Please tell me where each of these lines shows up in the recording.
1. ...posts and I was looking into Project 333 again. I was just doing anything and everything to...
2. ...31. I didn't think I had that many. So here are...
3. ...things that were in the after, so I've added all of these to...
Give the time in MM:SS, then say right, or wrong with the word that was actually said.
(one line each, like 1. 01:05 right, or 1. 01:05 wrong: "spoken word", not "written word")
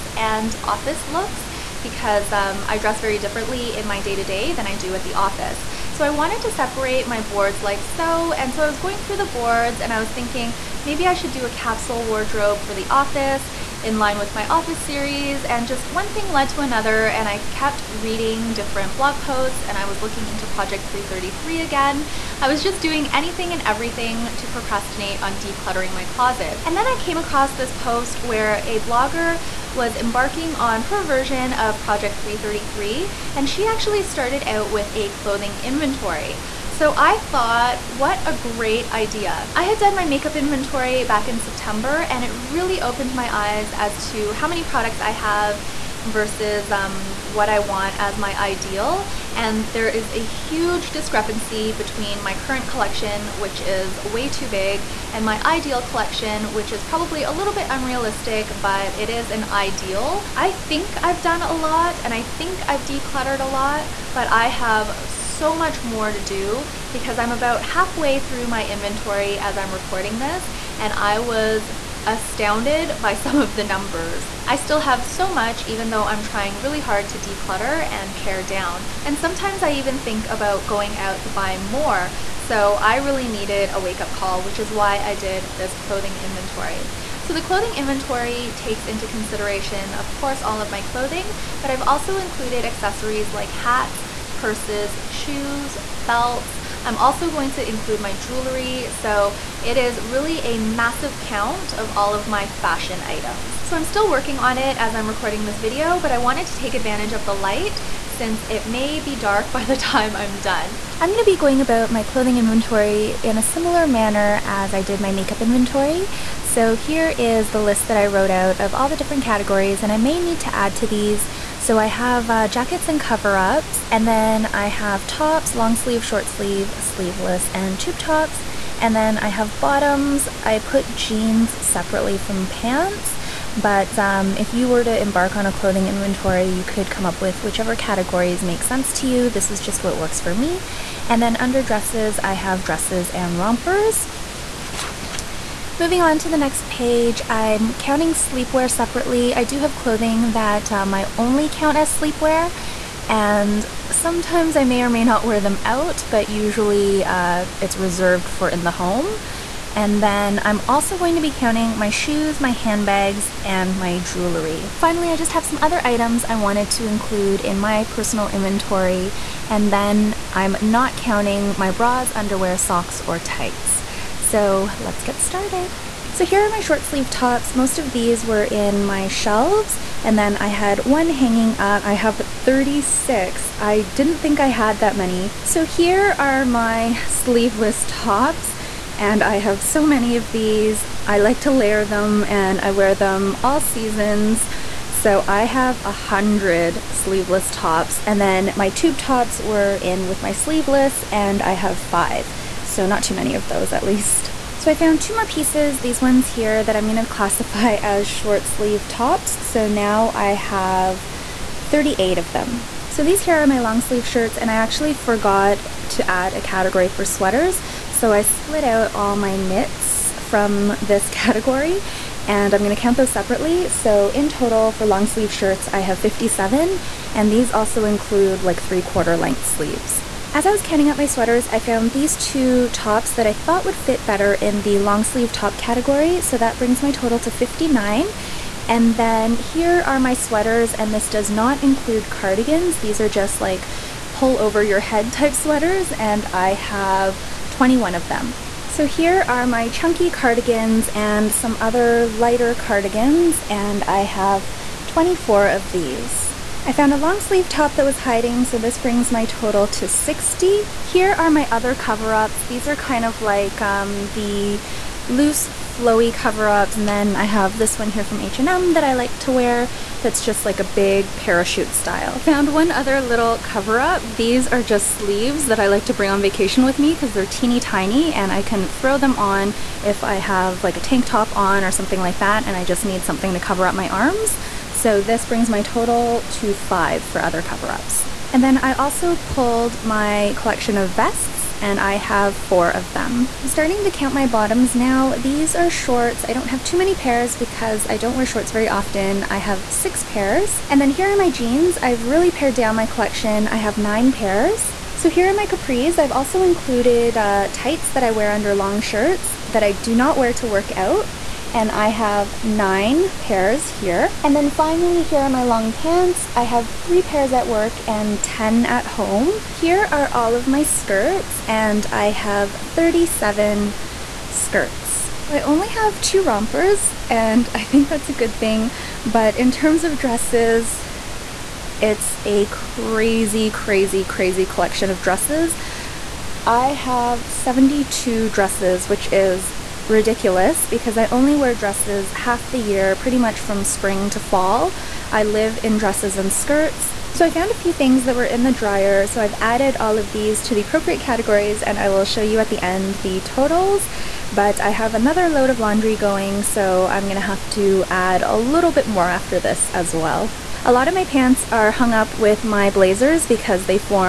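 1. 00:19 right
2. 03:02 wrong: "36", not "31"
3. 05:47 wrong: "dryer", not "after".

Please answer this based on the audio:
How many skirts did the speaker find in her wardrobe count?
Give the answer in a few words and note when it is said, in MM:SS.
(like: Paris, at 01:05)
37, at 05:22.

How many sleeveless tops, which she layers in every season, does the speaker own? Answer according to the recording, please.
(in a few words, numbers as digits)
100.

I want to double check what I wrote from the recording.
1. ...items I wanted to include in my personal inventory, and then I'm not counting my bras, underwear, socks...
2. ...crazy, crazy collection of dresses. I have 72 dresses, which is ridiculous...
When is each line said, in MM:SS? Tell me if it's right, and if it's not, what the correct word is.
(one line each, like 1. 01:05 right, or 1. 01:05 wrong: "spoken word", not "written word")
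1. 02:45 right
2. 05:33 right.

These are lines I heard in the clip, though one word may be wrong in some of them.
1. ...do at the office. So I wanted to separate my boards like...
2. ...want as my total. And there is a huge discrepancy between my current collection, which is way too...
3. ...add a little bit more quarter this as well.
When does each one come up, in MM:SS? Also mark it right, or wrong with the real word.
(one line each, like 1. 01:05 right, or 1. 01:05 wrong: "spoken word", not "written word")
1. 00:04 right
2. 00:47 wrong: "ideal", not "total"
3. 05:57 wrong: "after", not "quarter".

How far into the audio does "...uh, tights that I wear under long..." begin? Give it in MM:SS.
05:07.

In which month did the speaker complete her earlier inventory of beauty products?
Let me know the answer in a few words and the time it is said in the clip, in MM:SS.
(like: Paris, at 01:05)
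September, at 00:41.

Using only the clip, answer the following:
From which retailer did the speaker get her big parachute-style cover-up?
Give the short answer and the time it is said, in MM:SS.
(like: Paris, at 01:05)
H&M, at 04:28.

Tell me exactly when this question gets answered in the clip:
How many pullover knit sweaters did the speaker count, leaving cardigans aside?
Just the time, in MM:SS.
04:07.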